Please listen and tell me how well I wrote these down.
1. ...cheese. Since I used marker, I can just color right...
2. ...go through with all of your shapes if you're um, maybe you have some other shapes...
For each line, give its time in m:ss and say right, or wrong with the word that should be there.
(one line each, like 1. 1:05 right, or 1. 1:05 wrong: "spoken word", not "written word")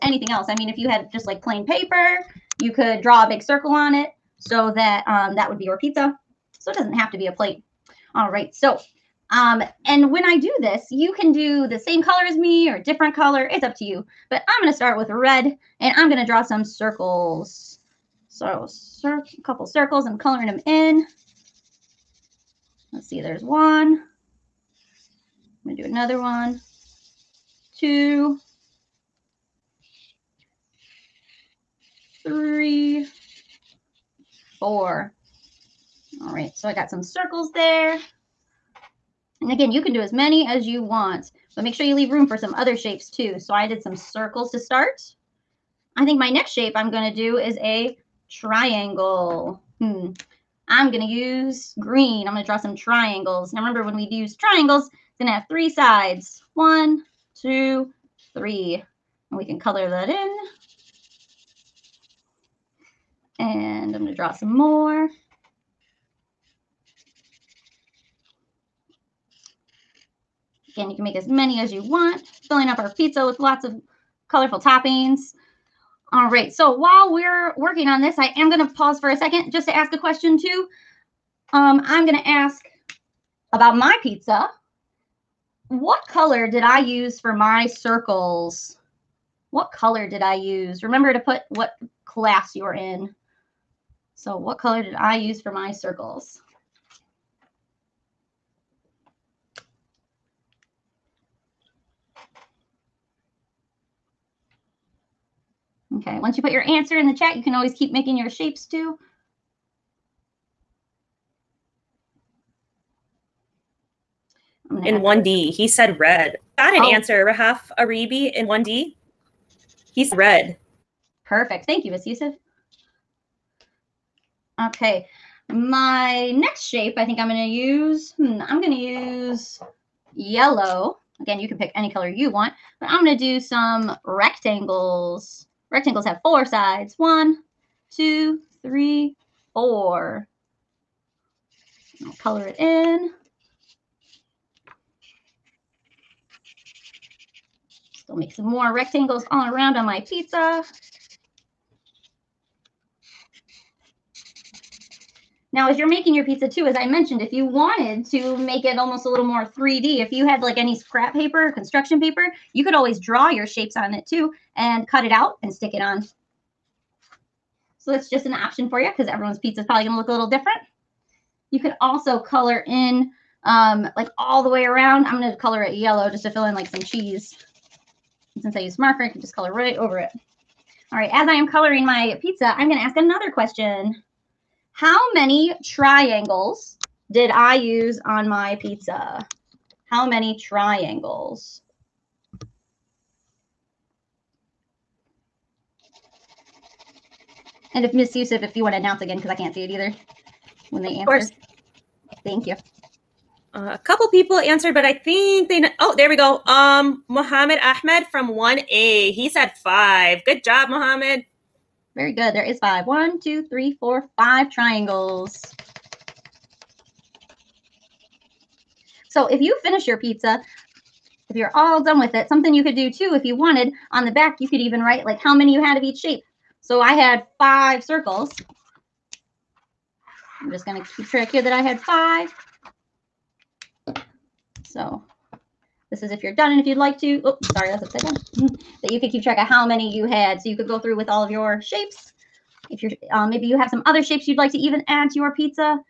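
1. 2:56 right
2. 4:00 right.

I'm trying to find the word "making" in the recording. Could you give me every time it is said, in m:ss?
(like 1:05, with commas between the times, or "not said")
1:47, 2:35.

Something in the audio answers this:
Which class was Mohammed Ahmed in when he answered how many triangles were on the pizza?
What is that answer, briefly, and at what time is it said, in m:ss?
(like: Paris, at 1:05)
1A, at 3:28.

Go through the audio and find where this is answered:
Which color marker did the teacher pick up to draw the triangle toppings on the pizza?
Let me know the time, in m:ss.
0:51.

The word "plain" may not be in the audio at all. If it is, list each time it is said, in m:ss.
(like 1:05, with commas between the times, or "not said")
0:01.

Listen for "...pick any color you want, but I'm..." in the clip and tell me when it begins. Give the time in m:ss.
2:11.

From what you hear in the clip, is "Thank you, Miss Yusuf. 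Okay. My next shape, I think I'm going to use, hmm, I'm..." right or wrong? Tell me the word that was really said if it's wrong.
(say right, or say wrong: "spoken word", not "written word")
right.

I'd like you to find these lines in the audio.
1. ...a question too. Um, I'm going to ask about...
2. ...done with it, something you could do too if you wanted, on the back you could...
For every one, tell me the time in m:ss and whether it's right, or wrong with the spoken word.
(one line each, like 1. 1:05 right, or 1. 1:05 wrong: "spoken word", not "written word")
1. 1:19 right
2. 3:41 right.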